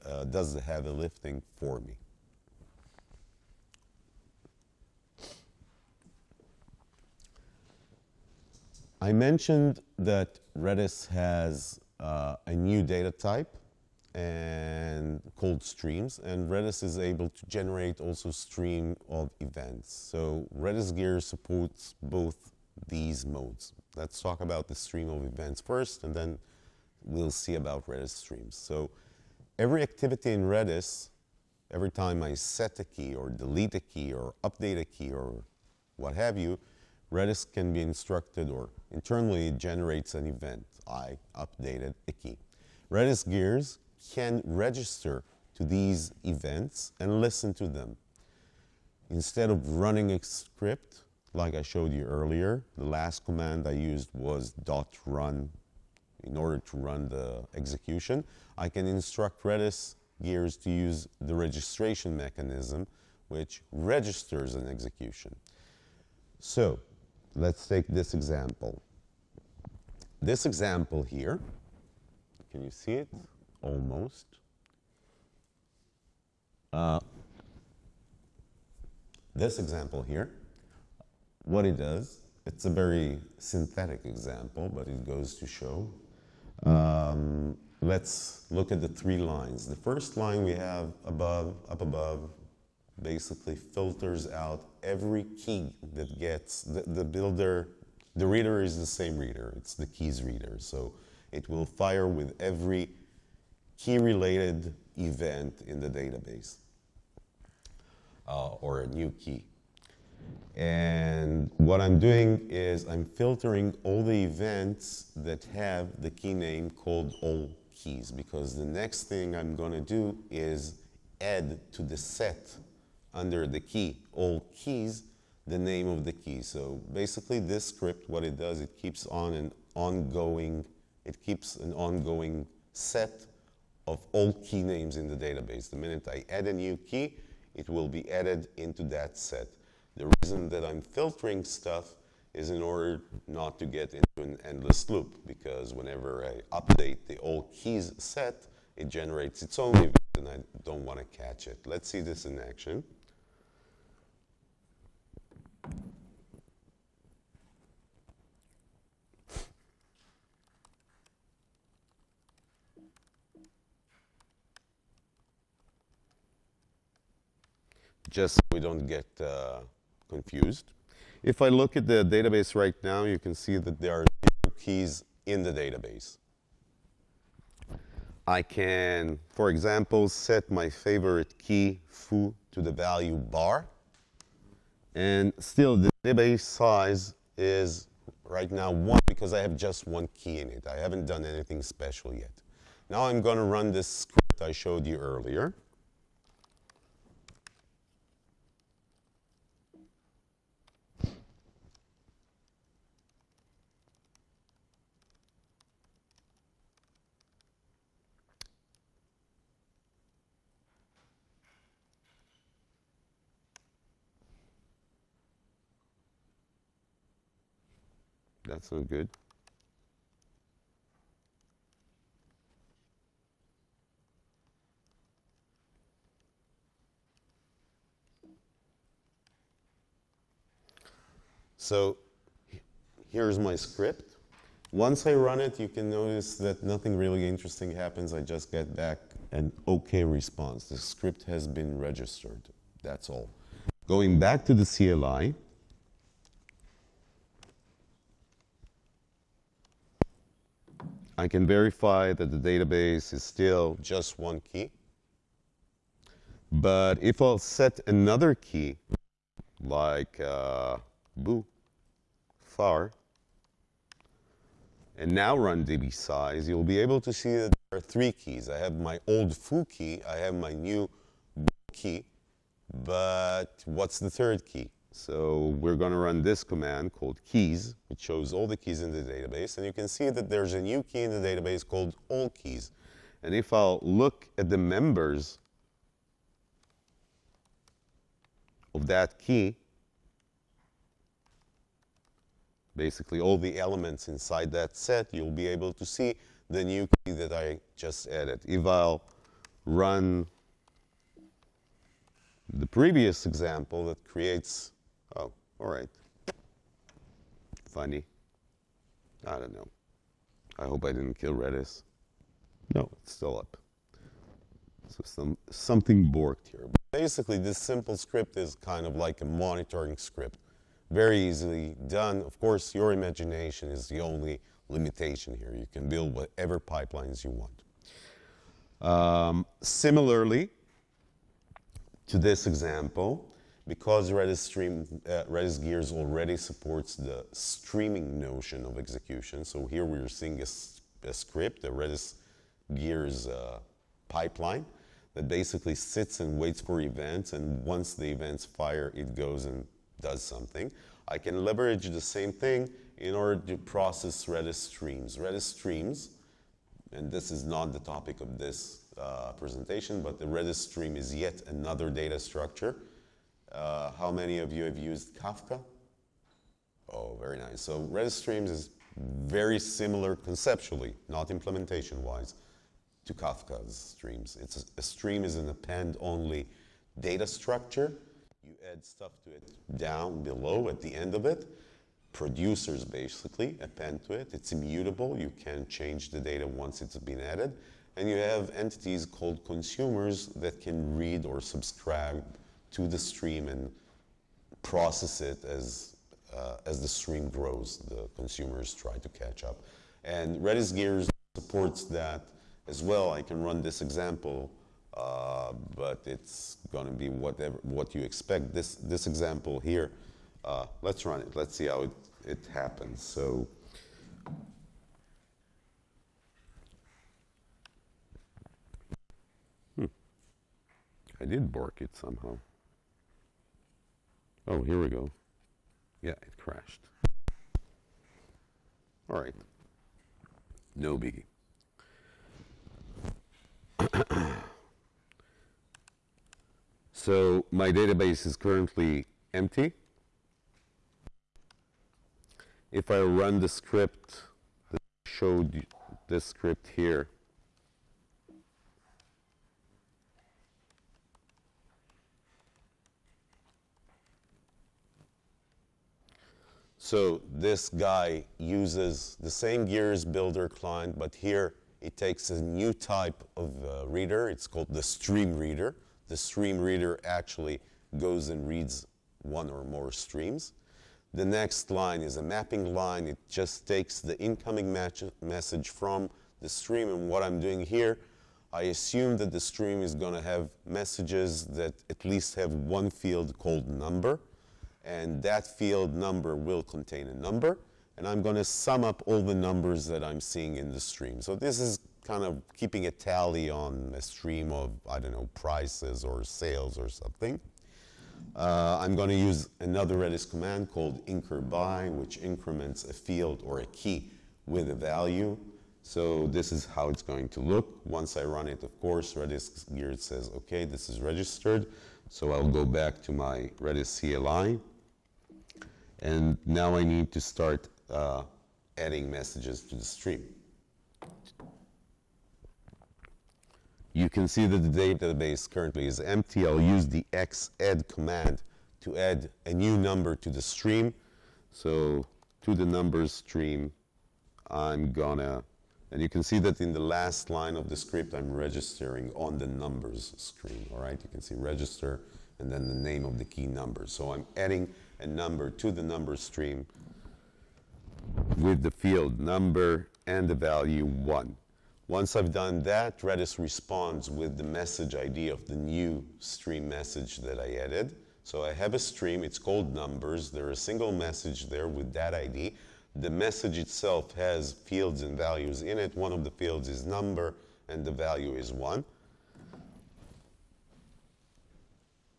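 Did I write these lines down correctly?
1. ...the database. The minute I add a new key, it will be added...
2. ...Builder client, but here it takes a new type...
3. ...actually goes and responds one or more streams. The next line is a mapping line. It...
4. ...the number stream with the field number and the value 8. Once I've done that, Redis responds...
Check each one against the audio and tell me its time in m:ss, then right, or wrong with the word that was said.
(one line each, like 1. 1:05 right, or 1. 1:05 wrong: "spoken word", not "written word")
1. 2:15 right
2. 7:40 right
3. 7:47 wrong: "reads", not "responds"
4. 9:05 wrong: "1", not "8".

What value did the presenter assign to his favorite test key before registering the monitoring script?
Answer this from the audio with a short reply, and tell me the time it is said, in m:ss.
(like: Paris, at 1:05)
bar, at 3:03.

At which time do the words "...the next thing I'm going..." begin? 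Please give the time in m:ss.
1:58.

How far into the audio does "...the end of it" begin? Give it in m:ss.
6:20.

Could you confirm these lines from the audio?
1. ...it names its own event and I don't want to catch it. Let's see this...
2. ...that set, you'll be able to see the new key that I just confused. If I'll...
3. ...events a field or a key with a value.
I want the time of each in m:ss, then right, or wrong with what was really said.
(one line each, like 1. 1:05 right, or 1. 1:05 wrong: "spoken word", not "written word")
1. 2:28 wrong: "generates", not "names"
2. 4:54 wrong: "added", not "confused"
3. 8:22 wrong: "increments", not "events".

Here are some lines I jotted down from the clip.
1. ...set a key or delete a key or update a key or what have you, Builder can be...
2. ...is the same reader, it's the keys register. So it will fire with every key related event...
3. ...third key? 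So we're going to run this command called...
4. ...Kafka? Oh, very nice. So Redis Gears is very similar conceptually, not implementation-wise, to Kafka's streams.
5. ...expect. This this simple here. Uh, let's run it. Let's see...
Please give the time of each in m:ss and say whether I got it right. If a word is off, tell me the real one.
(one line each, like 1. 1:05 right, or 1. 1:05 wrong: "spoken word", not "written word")
1. 0:32 wrong: "Redis", not "Builder"
2. 1:38 wrong: "reader", not "register"
3. 4:34 right
4. 6:05 wrong: "Streams", not "Gears"
5. 6:48 wrong: "example", not "simple".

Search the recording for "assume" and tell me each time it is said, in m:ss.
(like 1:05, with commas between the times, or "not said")
7:58.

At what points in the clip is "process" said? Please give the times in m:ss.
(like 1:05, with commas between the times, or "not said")
5:53, 6:34.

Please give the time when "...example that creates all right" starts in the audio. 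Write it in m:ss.
5:03.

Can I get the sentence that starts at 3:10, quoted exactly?
I haven't done anything special yet.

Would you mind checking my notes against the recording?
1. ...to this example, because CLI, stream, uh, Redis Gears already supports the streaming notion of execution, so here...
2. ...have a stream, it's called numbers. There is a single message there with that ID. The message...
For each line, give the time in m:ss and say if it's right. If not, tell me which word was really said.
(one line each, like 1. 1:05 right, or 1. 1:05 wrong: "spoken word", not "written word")
1. 5:32 wrong: "Redis", not "CLI"
2. 9:18 right.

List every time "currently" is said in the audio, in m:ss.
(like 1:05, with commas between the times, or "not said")
7:18, 8:45.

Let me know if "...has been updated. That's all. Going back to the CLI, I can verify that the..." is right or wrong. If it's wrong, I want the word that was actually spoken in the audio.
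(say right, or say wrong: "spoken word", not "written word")
wrong: "registered", not "updated".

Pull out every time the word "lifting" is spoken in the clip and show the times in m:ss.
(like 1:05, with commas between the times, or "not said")
0:00.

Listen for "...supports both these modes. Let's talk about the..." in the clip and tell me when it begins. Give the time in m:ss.
0:21.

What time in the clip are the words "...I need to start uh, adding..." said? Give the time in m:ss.
8:36.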